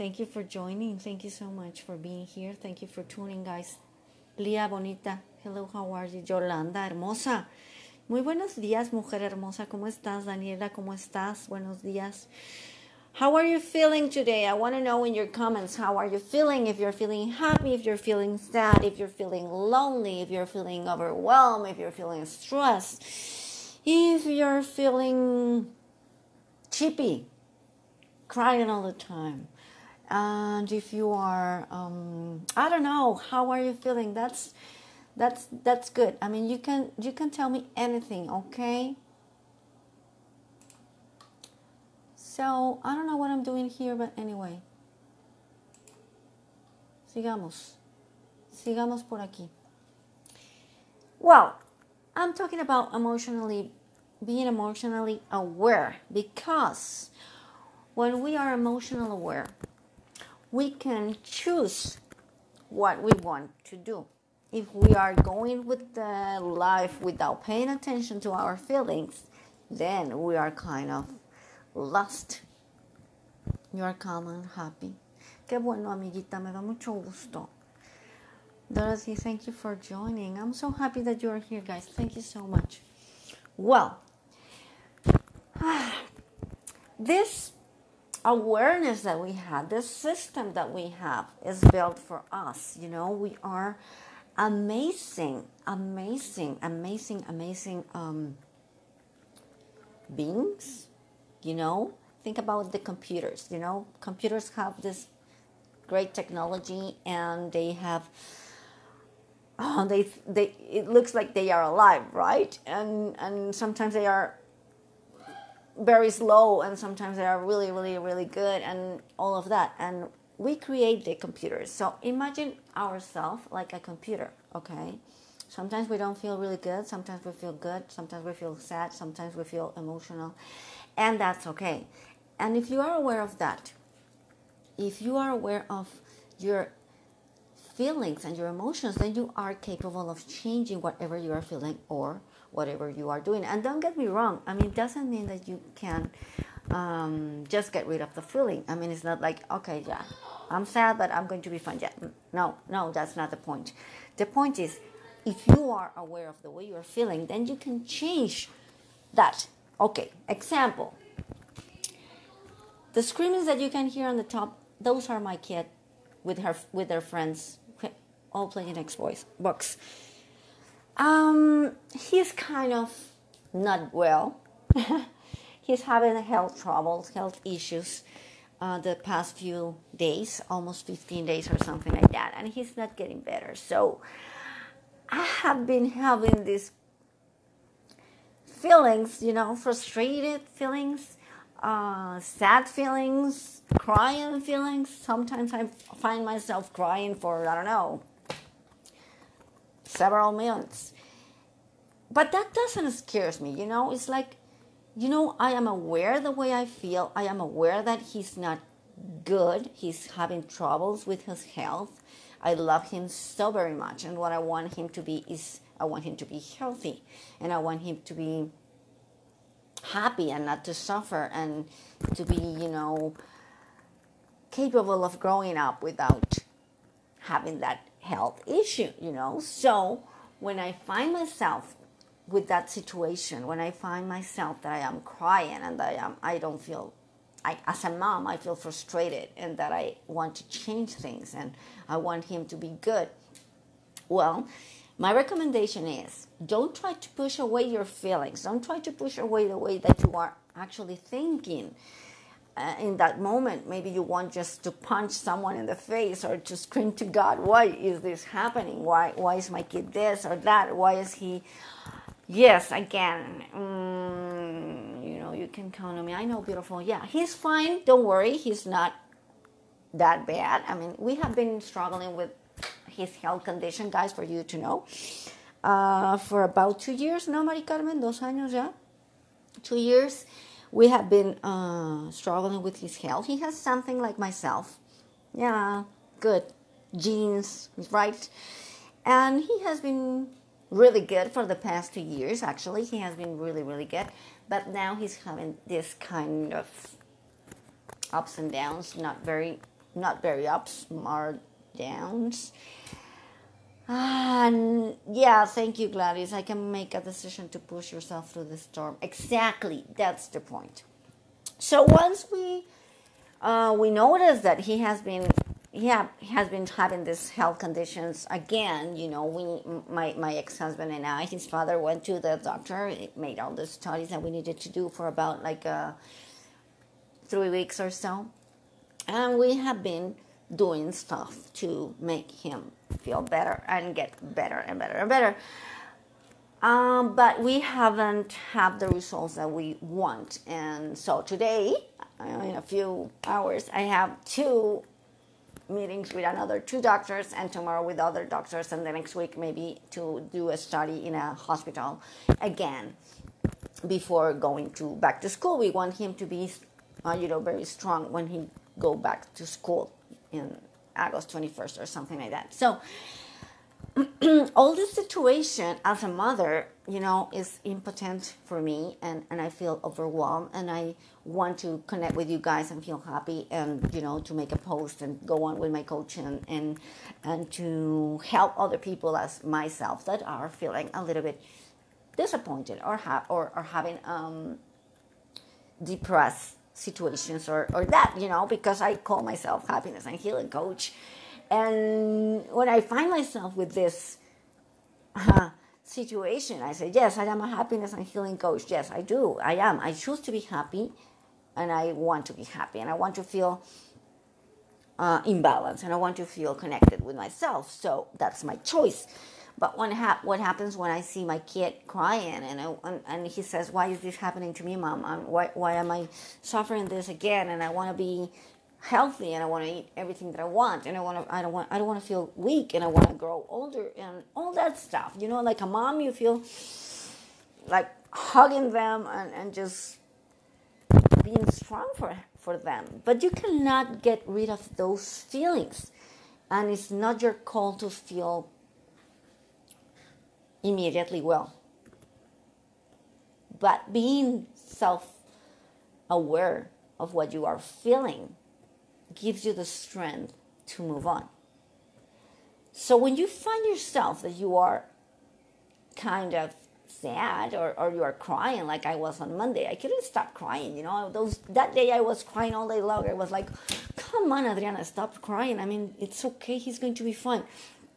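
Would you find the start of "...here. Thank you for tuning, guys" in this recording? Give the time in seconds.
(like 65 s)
2 s.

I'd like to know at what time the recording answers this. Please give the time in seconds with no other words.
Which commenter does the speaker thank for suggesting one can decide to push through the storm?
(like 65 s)
305 s.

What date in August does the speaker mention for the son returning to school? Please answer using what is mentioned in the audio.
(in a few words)
August 21.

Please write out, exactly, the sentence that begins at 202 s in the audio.
But that doesn't scare me, you know?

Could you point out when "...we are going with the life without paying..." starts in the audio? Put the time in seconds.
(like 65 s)
64 s.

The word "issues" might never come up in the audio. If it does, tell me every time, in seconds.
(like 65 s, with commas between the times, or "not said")
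177 s, 228 s.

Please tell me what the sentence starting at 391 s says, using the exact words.
And when I find myself with this uh, situation, I say, Yes, I am a happiness and healing coach.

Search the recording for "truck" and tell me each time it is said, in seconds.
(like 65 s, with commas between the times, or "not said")
not said.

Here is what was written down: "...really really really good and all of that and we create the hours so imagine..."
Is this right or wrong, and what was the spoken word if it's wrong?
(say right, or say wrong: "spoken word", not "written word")
wrong: "computers", not "hours".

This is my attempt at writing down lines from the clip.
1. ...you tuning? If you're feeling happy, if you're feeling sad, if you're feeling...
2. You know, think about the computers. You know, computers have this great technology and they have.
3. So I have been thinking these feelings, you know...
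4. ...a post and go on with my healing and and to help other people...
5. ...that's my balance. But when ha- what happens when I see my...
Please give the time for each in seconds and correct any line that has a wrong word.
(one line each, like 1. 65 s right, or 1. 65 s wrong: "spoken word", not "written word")
1. 16 s wrong: "feeling", not "tuning"
2. 101 s right
3. 183 s wrong: "having", not "thinking"
4. 374 s wrong: "coaching", not "healing"
5. 408 s wrong: "choice", not "balance".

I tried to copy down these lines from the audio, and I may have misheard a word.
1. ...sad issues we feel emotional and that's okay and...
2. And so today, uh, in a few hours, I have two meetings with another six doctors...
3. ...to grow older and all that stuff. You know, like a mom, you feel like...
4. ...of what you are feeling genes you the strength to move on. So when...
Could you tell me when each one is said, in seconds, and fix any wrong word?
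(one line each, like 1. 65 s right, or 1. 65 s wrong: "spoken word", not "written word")
1. 128 s wrong: "sometimes", not "issues"
2. 340 s wrong: "two", not "six"
3. 423 s right
4. 446 s wrong: "gives", not "genes".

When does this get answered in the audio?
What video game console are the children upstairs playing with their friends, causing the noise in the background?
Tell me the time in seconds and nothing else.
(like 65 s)
168 s.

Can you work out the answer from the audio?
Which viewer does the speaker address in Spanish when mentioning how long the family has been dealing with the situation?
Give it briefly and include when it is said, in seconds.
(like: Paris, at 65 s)
Mari Carmen, at 277 s.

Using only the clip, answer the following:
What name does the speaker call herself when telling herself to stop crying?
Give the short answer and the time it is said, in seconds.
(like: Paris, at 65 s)
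Adriana, at 464 s.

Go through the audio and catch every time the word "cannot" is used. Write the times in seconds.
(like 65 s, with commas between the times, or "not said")
433 s.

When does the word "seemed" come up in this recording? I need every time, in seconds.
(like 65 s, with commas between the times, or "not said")
not said.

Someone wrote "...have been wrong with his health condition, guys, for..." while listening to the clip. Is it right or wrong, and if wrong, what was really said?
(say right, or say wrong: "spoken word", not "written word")
wrong: "struggling", not "wrong".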